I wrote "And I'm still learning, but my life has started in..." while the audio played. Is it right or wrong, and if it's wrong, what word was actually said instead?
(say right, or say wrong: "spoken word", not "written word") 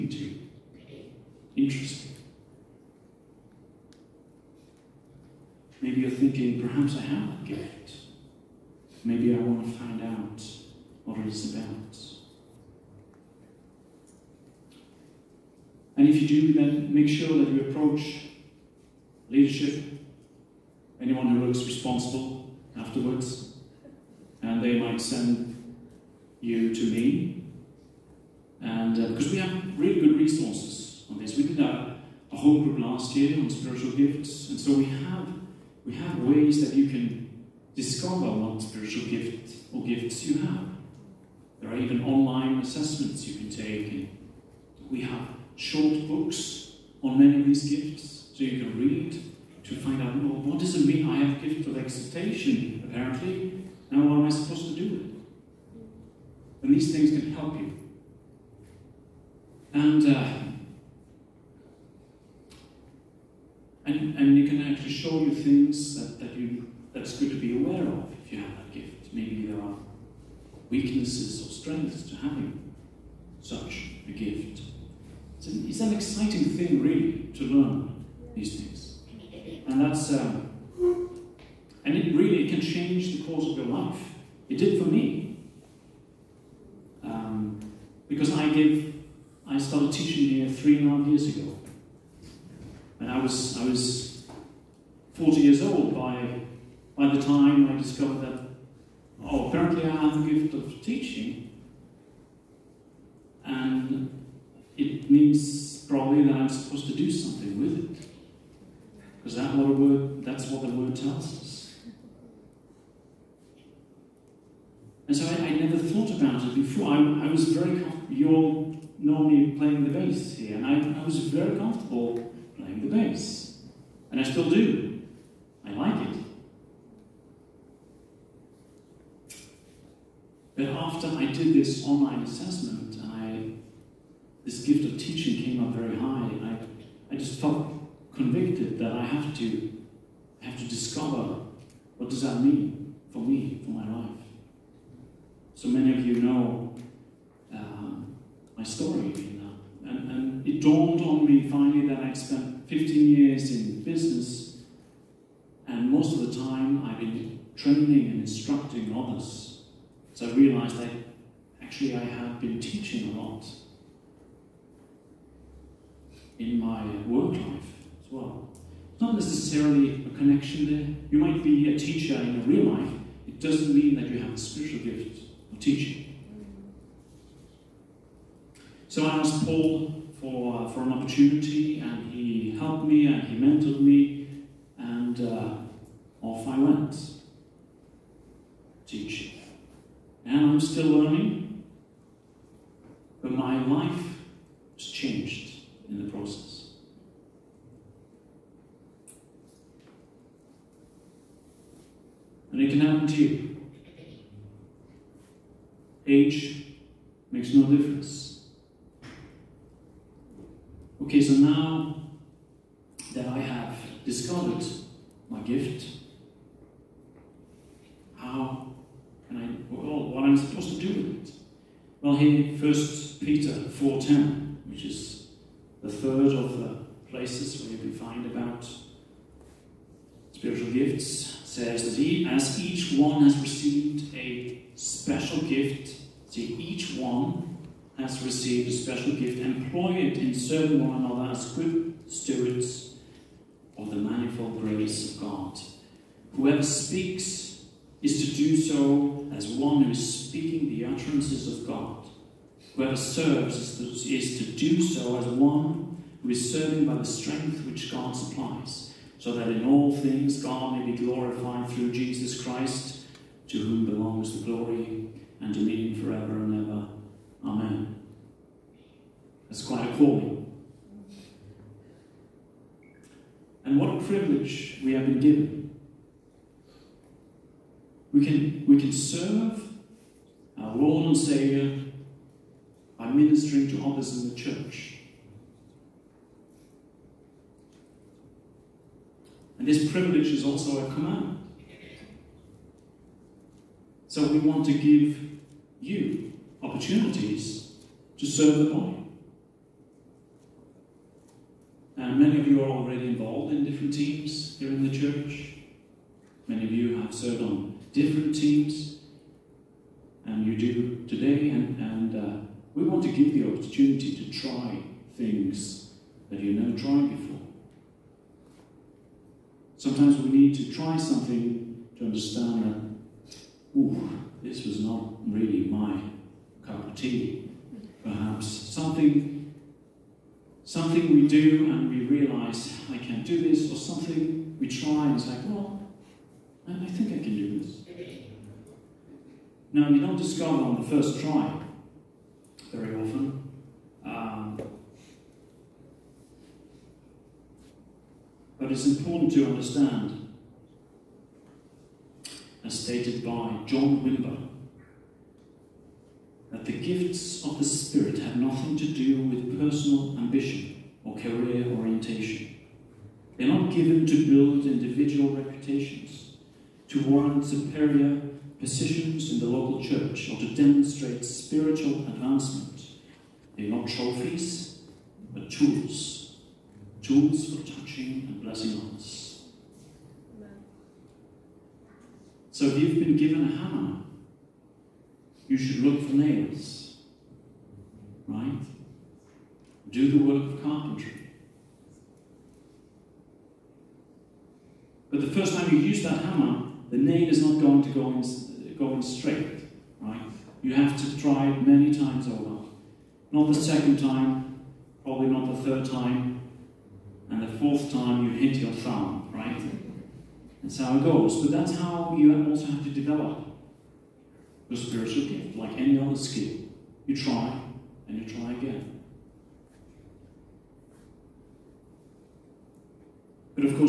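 wrong: "changed", not "started".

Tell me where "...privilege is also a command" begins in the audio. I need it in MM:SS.
04:49.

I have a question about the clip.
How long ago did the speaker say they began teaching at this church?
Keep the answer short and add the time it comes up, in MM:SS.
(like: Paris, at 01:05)
3.5 years ago, at 01:30.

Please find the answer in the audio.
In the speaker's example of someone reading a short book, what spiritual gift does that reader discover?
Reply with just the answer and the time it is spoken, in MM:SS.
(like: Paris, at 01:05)
Exhortation, at 00:51.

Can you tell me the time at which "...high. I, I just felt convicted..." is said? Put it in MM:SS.
02:15.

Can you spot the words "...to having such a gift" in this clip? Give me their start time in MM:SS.
01:12.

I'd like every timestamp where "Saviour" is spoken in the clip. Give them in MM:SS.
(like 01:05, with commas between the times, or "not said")
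04:41.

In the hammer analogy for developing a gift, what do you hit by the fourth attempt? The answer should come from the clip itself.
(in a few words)
Your thumb.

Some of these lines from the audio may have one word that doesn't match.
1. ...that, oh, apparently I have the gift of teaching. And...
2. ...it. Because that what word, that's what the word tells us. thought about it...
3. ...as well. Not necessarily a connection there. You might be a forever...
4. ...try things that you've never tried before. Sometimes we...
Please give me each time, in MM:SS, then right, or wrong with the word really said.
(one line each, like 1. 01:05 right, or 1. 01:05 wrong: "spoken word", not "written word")
1. 01:38 right
2. 01:47 right
3. 02:48 wrong: "teacher", not "forever"
4. 05:14 right.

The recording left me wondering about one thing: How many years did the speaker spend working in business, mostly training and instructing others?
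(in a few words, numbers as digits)
15 years.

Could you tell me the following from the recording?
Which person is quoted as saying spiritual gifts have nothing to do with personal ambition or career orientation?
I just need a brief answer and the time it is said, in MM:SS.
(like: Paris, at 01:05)
John Wimber, at 05:53.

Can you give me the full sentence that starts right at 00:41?
There are even online assessments you can take.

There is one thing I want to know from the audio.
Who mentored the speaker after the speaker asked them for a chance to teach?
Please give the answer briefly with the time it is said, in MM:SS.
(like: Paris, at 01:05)
Paul, at 02:59.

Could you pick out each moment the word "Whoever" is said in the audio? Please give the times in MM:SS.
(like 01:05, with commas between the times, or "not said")
04:06, 04:12.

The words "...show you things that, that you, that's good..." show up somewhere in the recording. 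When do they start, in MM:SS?
01:04.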